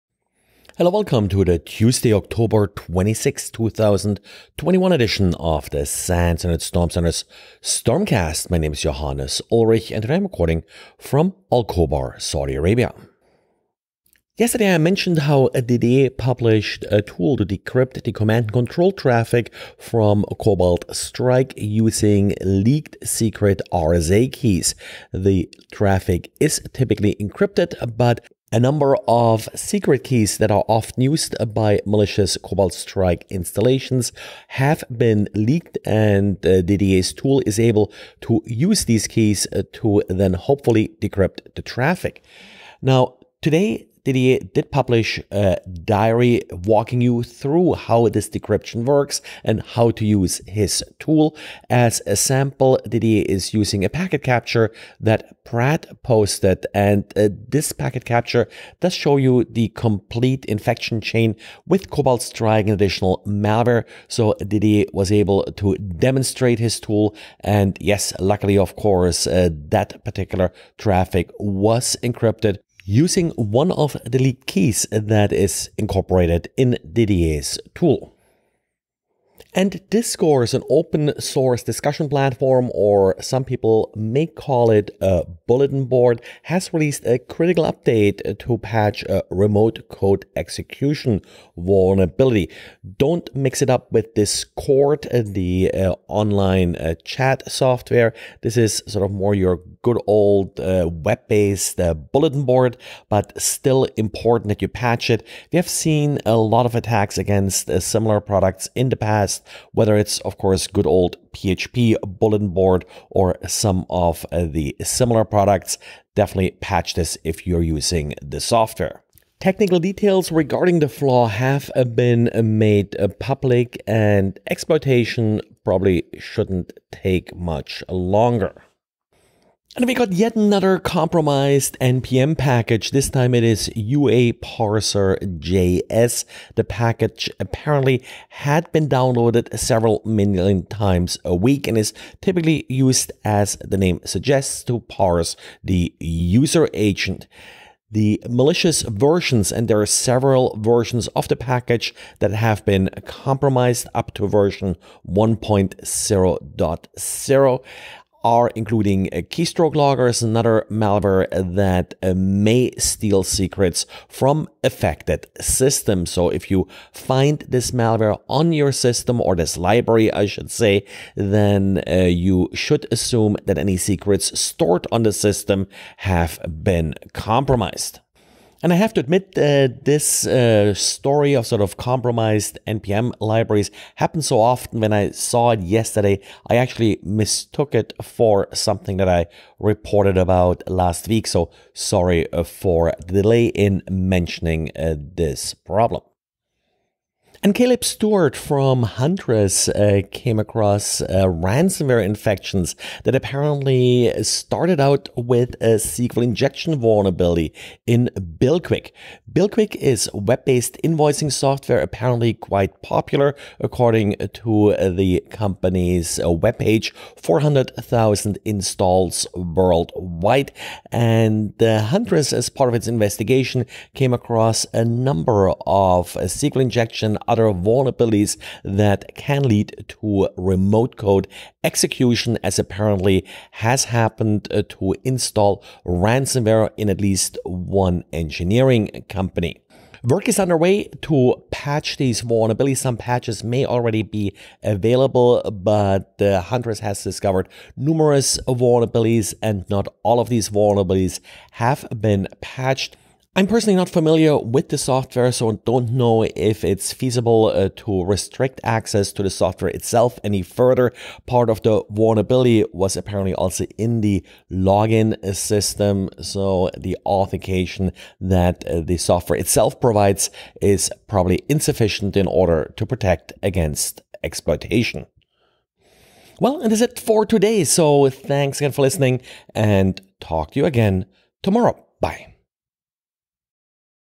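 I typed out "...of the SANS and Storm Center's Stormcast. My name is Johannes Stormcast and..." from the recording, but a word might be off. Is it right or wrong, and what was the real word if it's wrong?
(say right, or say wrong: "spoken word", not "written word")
wrong: "Ulrich", not "Stormcast".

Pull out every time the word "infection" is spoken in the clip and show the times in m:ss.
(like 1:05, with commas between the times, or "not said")
1:00, 3:22.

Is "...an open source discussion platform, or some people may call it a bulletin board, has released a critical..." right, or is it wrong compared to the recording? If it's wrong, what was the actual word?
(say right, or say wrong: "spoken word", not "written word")
right.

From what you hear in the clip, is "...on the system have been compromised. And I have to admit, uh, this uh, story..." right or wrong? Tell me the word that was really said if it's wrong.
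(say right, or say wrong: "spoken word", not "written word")
right.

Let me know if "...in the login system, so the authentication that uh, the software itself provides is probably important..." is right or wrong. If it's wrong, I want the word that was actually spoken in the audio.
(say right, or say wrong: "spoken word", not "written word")
wrong: "insufficient", not "important".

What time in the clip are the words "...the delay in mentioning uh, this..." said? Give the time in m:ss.
3:13.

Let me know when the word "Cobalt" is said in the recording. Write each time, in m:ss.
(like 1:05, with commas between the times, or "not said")
0:20, 0:32, 1:01.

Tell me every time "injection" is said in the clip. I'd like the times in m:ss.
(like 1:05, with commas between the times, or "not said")
3:26, 3:46.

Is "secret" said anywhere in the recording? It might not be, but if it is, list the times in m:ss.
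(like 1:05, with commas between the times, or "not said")
0:23, 0:29, 2:43, 2:53.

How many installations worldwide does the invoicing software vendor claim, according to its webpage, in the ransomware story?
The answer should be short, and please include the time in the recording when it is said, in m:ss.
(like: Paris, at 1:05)
400,000, at 3:37.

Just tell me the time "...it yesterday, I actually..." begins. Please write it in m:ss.
3:05.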